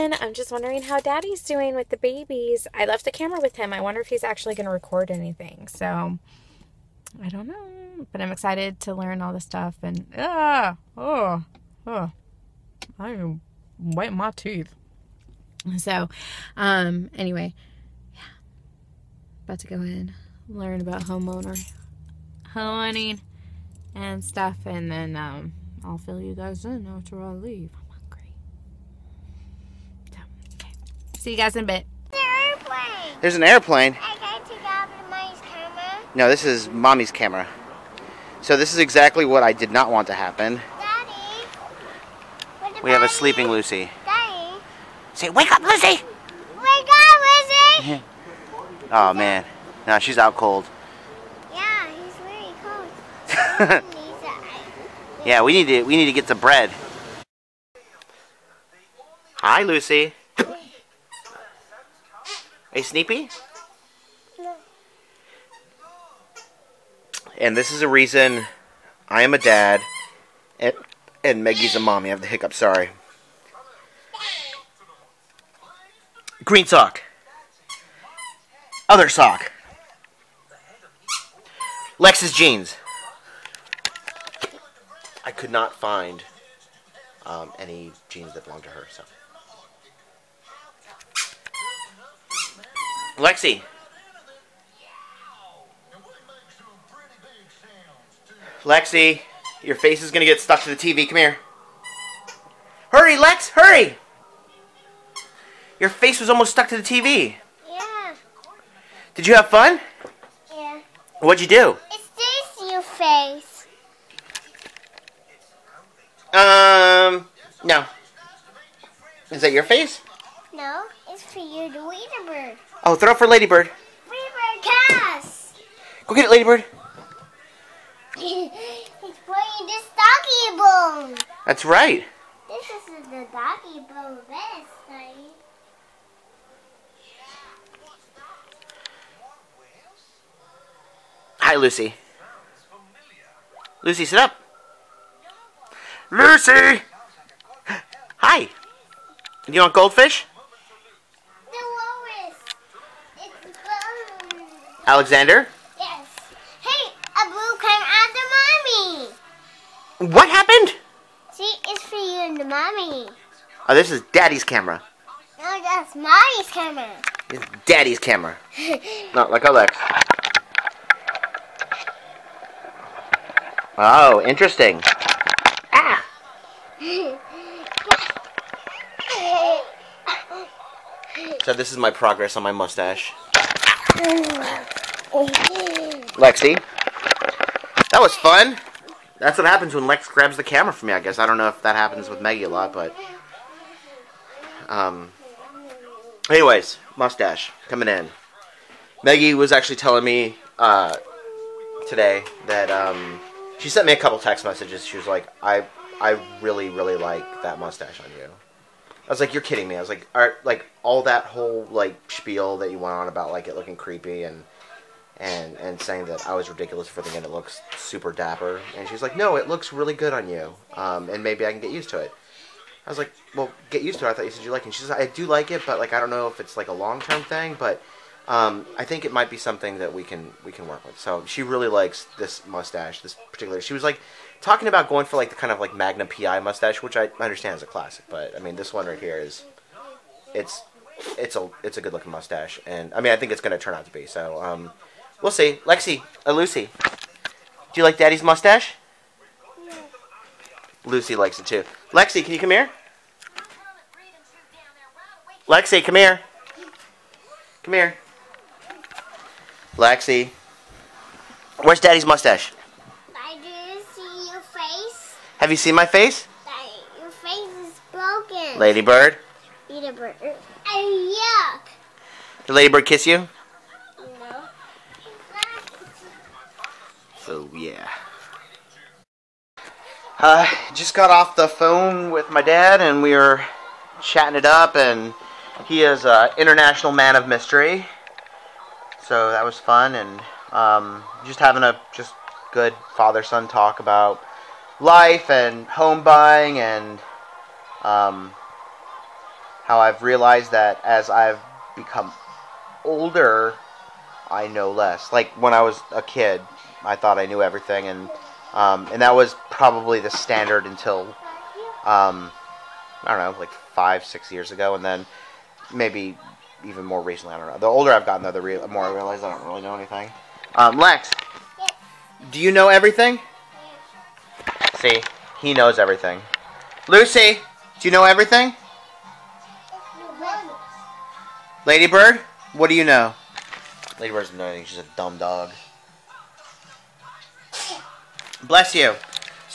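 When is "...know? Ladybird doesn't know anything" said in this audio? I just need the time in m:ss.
5:32.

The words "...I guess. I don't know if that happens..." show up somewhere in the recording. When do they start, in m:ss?
3:10.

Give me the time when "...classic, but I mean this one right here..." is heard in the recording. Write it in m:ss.
3:57.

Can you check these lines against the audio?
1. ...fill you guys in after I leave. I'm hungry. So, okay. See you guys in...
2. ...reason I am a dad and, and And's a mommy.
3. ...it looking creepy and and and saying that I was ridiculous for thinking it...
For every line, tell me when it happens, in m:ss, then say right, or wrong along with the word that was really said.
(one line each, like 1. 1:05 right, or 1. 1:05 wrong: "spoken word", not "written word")
1. 0:25 right
2. 1:07 wrong: "Maggie", not "And"
3. 3:33 right.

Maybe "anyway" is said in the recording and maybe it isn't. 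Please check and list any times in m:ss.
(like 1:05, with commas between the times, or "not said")
0:17, 3:16.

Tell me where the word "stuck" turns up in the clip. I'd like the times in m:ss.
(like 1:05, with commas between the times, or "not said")
1:40, 1:46.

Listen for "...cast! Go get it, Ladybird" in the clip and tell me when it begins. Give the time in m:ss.
2:04.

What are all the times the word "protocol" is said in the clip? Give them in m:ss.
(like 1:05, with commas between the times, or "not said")
not said.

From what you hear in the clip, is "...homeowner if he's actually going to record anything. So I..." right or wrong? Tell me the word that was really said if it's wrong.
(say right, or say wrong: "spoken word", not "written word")
wrong: "wonder", not "homeowner".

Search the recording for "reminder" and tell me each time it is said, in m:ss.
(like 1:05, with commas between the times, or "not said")
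not said.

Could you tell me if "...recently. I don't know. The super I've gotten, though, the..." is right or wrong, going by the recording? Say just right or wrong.
wrong.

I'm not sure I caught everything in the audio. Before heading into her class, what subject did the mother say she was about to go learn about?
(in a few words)
Homeowning.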